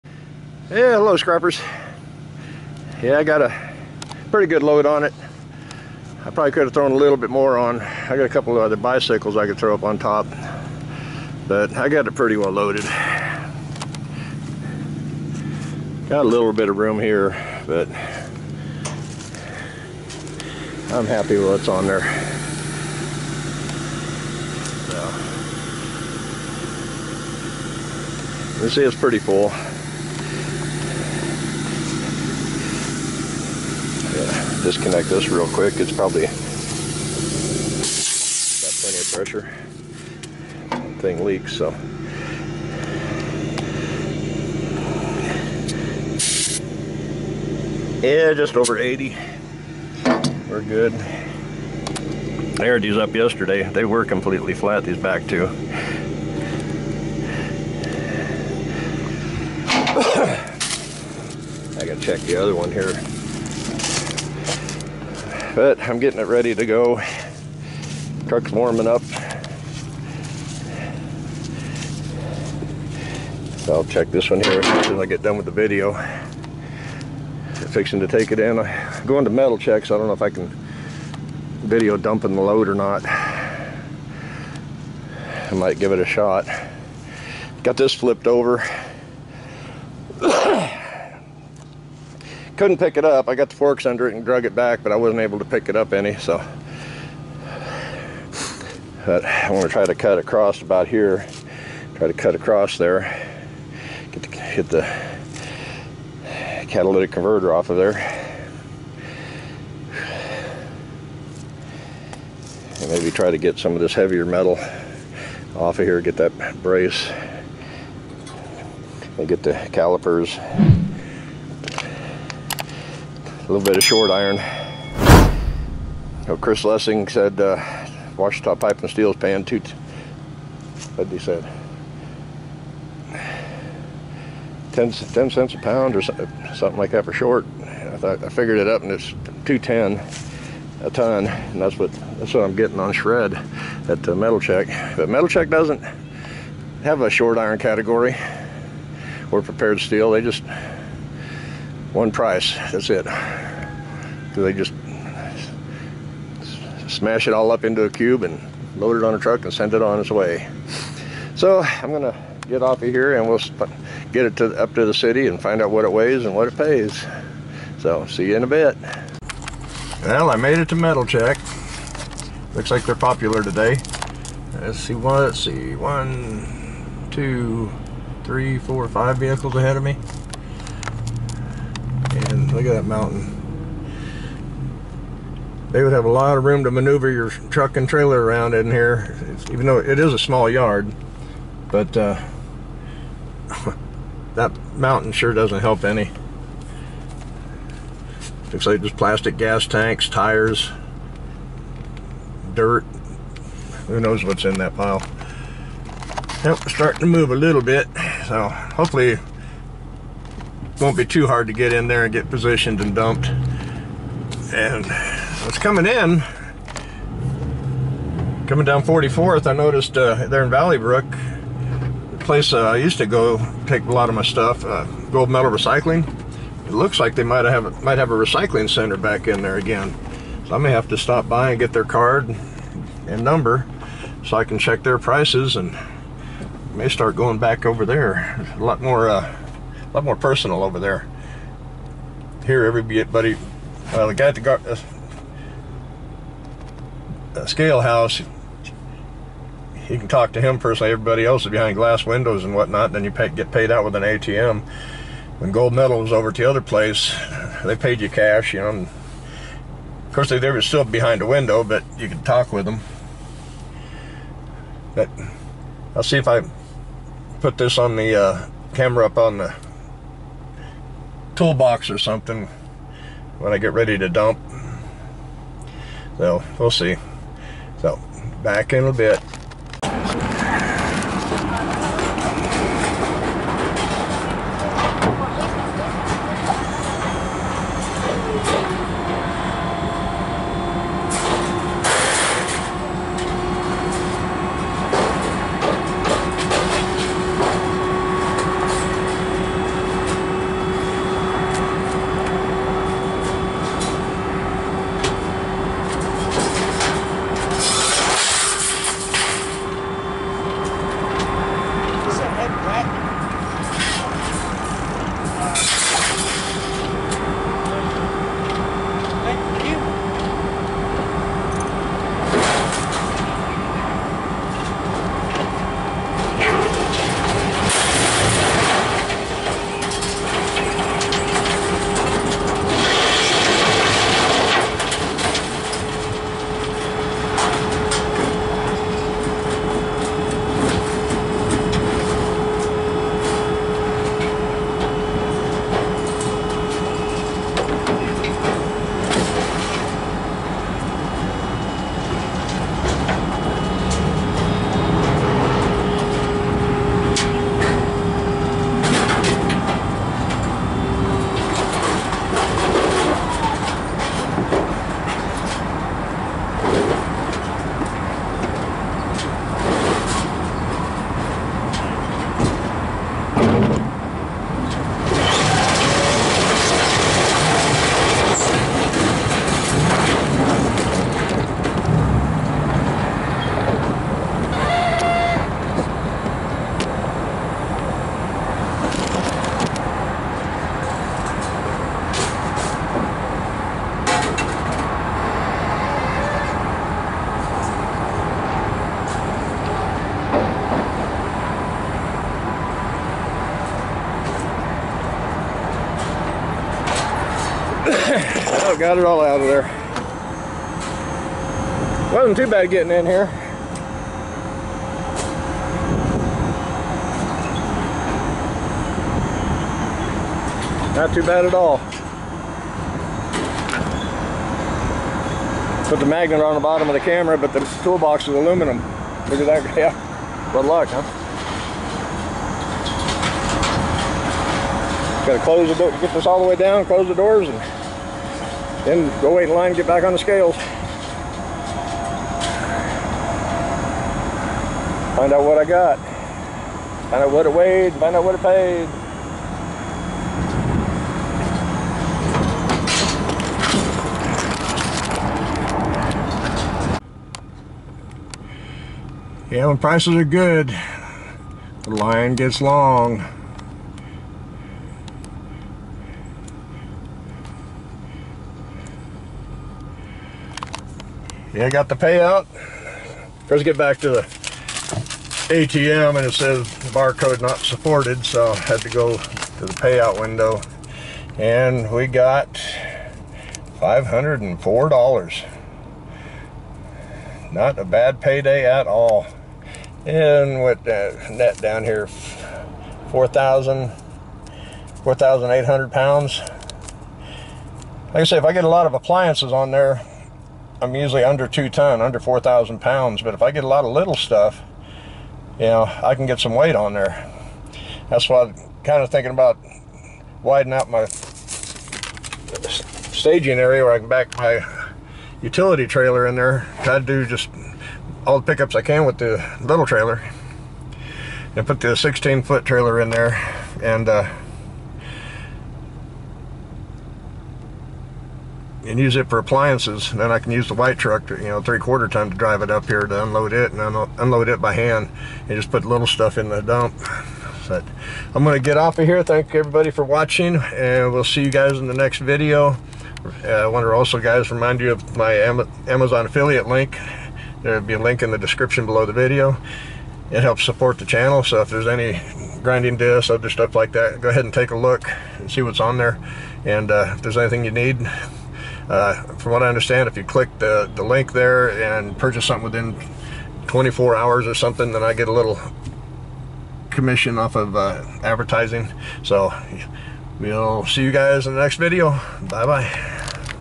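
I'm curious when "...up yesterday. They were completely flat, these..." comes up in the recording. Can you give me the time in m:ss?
0:52.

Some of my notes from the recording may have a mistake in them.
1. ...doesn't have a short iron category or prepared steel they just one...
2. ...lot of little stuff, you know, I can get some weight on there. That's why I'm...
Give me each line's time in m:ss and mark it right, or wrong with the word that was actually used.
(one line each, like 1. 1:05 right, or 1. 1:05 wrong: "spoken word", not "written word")
1. 2:25 right
2. 8:23 right.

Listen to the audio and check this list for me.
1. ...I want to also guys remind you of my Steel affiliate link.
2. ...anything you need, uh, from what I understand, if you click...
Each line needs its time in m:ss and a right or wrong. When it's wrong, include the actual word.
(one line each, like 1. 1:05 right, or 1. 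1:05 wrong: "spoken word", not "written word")
1. 9:03 wrong: "Amazon", not "Steel"
2. 9:17 right.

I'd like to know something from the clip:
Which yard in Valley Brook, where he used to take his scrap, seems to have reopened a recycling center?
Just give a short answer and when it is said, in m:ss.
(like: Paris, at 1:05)
Gold Medal Recycling, at 3:45.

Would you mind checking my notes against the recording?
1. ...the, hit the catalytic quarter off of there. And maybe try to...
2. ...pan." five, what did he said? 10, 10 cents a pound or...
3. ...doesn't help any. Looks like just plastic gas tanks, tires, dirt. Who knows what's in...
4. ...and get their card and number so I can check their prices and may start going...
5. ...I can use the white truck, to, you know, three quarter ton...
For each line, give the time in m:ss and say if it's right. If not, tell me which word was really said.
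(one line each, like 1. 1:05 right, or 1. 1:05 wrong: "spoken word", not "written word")
1. 1:44 wrong: "converter", not "quarter"
2. 2:09 wrong: "two", not "five"
3. 3:15 right
4. 3:51 right
5. 8:50 right.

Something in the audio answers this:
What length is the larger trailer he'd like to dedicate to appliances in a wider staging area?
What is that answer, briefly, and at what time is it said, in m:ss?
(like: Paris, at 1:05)
16 foot, at 8:41.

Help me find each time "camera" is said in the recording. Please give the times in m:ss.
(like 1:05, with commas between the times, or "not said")
4:28, 7:07.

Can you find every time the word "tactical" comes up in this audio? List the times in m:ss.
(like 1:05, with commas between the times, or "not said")
not said.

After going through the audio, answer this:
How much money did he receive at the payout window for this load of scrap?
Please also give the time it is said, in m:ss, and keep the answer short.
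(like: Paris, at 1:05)
$504, at 8:03.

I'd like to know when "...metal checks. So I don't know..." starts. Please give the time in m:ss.
1:19.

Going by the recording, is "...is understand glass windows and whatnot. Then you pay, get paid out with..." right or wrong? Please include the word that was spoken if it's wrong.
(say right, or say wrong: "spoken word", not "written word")
wrong: "behind", not "understand".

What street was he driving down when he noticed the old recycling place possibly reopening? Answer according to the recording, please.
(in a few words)
44th.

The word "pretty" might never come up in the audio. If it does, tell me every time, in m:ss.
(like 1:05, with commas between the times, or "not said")
0:04, 0:12, 0:28.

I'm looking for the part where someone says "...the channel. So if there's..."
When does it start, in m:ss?
9:10.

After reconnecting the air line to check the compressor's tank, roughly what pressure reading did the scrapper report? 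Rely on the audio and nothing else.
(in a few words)
just over 80.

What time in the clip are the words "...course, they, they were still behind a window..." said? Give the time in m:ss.
4:20.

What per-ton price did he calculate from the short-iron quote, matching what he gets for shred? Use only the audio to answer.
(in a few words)
210.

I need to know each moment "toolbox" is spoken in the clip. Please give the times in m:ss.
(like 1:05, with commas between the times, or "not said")
4:31, 7:07.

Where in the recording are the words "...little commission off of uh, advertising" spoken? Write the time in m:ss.
9:25.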